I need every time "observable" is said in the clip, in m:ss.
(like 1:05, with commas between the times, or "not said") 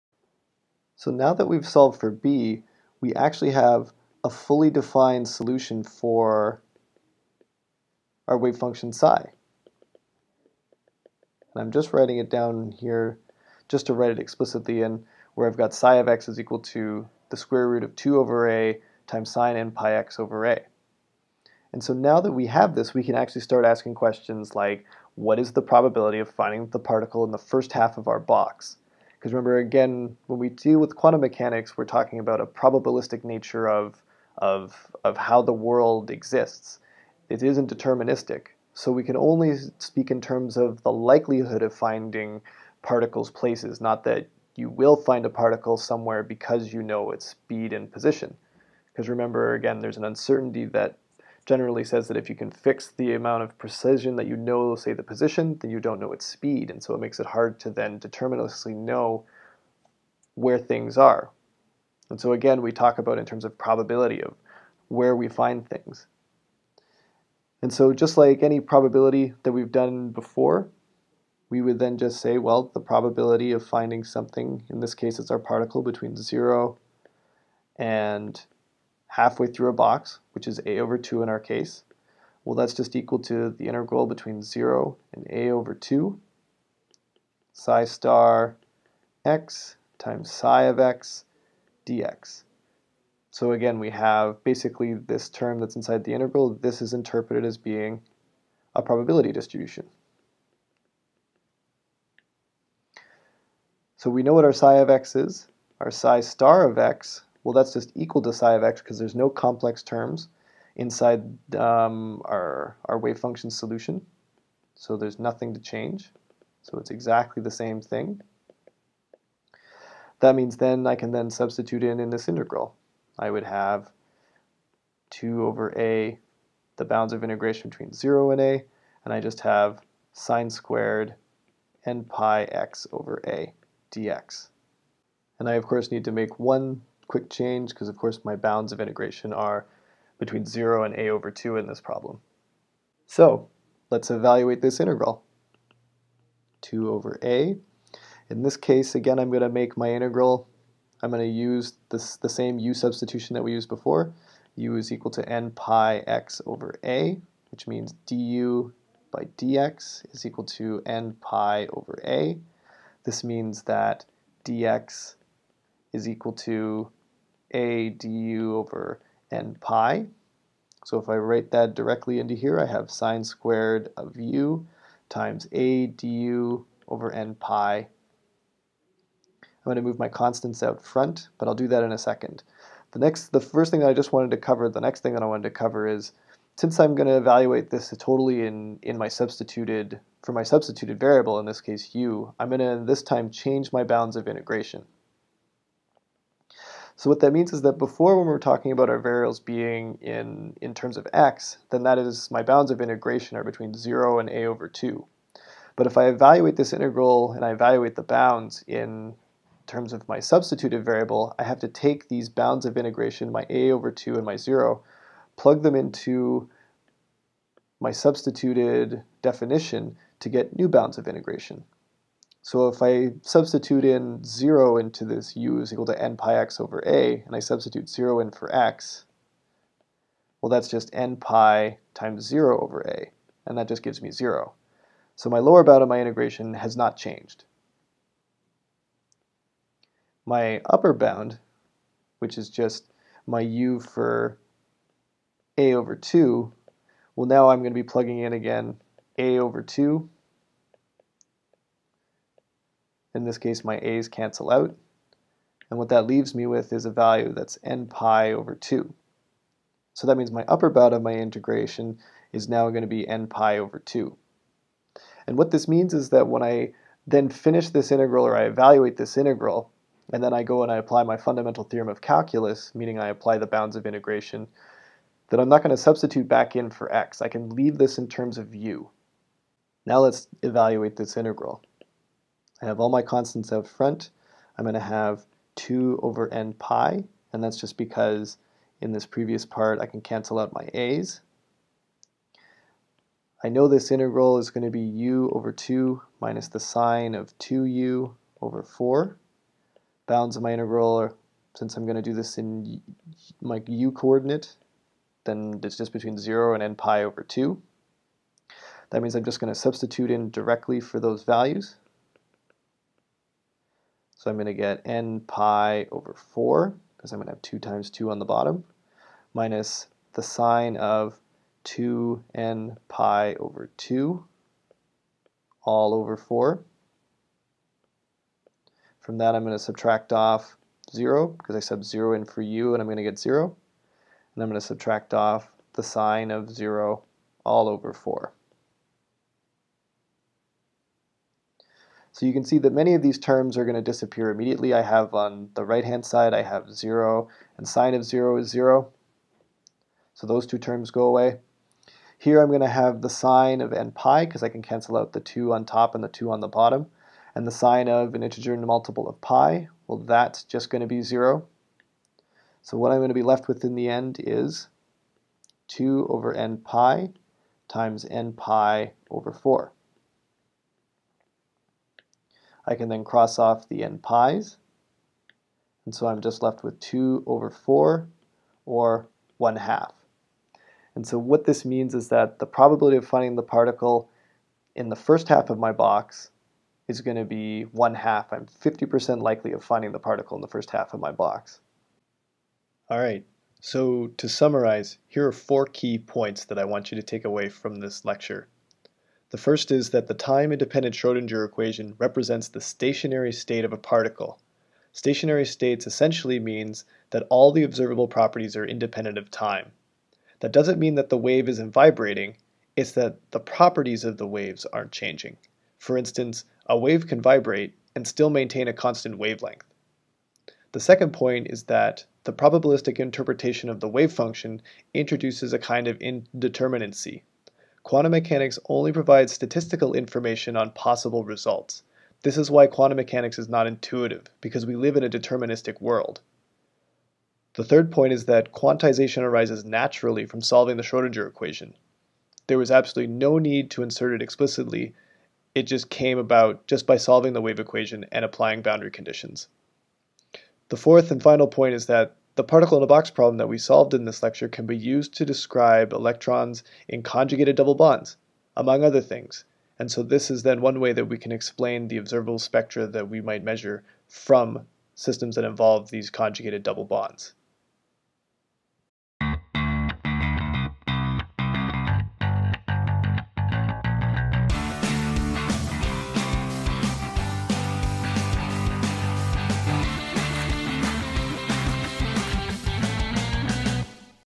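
6:47, 7:41.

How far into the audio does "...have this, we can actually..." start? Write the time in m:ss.
0:22.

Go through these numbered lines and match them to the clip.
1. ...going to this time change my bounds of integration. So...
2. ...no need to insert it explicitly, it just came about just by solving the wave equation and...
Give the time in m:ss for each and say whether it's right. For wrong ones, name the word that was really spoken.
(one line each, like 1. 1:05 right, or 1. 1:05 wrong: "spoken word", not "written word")
1. 3:12 right
2. 7:23 right.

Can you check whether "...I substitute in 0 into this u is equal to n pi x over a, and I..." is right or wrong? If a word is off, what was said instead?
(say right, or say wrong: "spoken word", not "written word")
right.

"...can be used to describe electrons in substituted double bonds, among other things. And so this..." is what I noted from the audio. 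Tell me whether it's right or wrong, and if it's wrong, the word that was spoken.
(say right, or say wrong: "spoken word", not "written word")
wrong: "conjugated", not "substituted".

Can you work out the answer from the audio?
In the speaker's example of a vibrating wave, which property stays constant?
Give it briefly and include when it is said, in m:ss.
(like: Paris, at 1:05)
wavelength, at 6:58.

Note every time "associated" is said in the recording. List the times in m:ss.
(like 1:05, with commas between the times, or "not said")
not said.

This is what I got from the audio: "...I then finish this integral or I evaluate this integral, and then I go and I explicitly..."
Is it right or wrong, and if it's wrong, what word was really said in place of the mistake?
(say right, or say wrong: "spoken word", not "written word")
wrong: "apply", not "explicitly".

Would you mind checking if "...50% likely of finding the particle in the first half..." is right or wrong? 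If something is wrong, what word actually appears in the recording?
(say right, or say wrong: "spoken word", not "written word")
right.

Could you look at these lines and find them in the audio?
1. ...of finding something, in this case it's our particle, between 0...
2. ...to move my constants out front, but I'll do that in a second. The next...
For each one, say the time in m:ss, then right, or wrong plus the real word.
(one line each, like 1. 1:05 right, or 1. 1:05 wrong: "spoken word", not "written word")
1. 1:13 right
2. 2:59 right.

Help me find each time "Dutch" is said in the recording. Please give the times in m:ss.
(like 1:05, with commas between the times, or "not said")
not said.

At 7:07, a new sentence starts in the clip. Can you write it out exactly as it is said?
Quantum mechanics only provides statistical information on possible results.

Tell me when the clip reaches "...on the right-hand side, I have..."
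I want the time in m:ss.
5:45.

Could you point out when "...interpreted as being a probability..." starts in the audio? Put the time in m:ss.
1:36.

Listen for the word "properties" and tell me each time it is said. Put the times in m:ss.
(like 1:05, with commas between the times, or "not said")
6:48, 6:53.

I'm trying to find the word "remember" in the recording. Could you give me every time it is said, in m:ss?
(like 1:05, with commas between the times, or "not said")
0:29, 0:49.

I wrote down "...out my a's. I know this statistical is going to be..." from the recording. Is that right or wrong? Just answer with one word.
wrong.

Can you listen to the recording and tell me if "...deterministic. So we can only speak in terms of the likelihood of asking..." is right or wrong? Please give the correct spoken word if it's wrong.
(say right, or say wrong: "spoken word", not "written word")
wrong: "finding", not "asking".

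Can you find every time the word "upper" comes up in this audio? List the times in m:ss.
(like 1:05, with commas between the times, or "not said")
4:00, 4:20.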